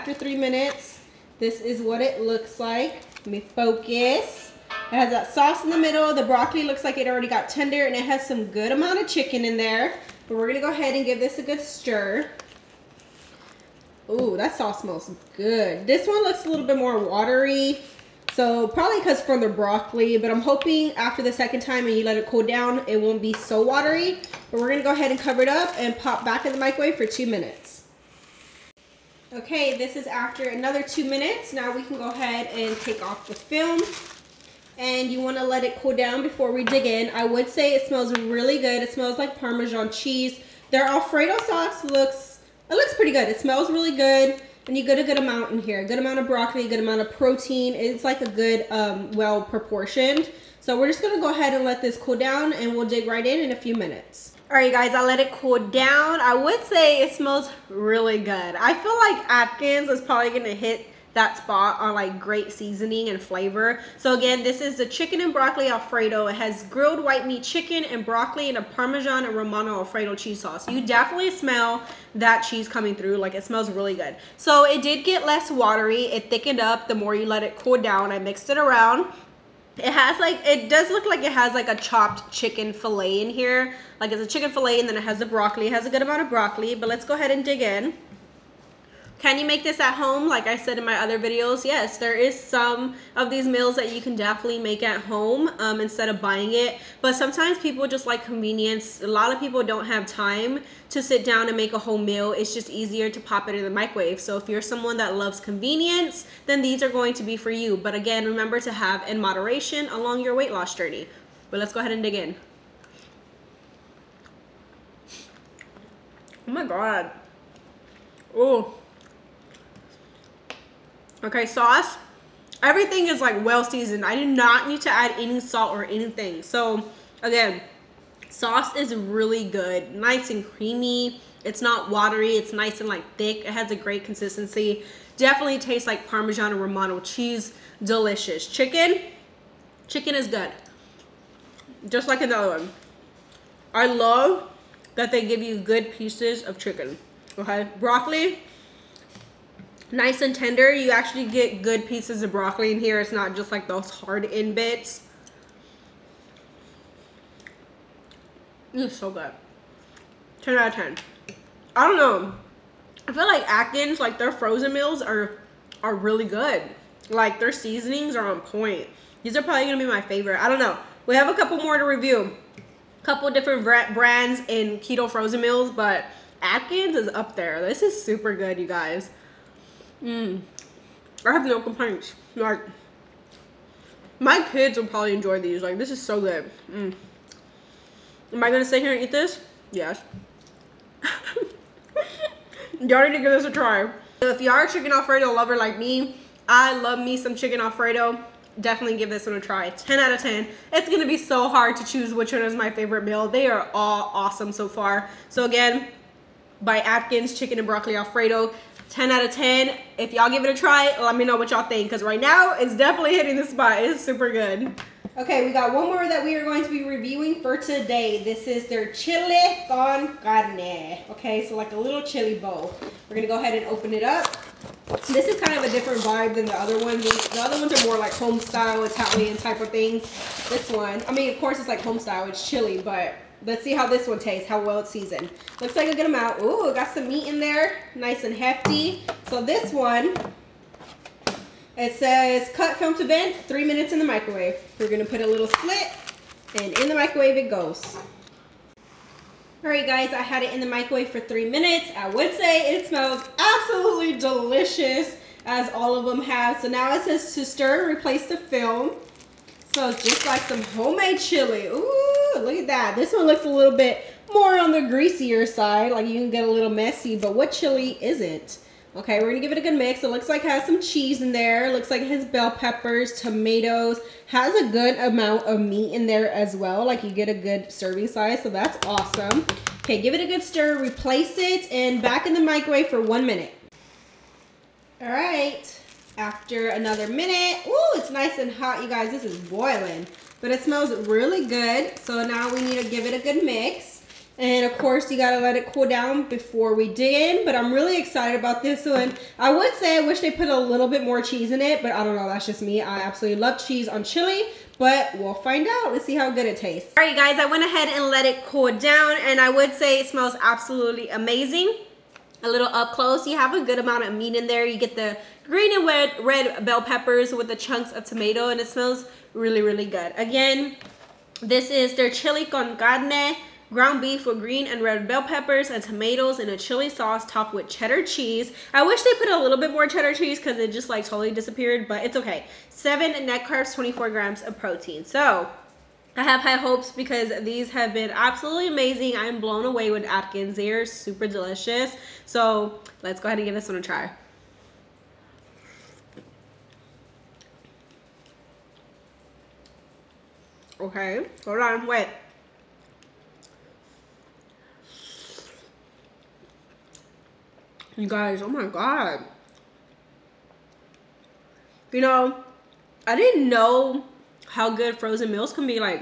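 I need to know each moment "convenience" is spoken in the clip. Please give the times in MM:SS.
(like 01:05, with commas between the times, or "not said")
01:38, 01:45.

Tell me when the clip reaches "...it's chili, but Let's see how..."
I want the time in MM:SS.
03:52.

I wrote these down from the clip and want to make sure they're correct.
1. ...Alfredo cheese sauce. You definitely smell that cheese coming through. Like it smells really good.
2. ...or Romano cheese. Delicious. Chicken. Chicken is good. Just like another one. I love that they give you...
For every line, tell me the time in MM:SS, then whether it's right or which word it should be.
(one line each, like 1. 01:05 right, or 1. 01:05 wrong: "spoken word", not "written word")
1. 01:09 right
2. 02:16 right.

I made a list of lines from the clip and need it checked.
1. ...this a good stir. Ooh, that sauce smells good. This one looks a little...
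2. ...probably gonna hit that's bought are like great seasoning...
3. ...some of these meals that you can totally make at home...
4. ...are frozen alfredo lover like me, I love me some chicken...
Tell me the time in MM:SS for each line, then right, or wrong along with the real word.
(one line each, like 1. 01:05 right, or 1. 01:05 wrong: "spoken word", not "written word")
1. 00:11 right
2. 01:00 right
3. 01:32 wrong: "definitely", not "totally"
4. 03:14 wrong: "chicken", not "frozen".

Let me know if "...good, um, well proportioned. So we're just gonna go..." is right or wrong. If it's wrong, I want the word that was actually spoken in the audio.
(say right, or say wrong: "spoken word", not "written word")
right.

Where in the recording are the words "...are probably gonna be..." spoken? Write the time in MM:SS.
02:49.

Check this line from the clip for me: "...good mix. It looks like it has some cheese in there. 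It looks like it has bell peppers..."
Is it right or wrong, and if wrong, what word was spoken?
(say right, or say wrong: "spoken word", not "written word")
right.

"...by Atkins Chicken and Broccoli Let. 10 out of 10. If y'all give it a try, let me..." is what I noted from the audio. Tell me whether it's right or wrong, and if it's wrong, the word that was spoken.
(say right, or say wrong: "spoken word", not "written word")
wrong: "Alfredo", not "Let".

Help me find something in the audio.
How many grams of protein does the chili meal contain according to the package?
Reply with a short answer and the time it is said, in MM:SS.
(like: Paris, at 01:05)
24 grams, at 05:33.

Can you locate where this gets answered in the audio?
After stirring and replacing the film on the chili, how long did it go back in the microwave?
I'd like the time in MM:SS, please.
04:43.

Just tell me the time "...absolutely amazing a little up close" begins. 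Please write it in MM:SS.
05:10.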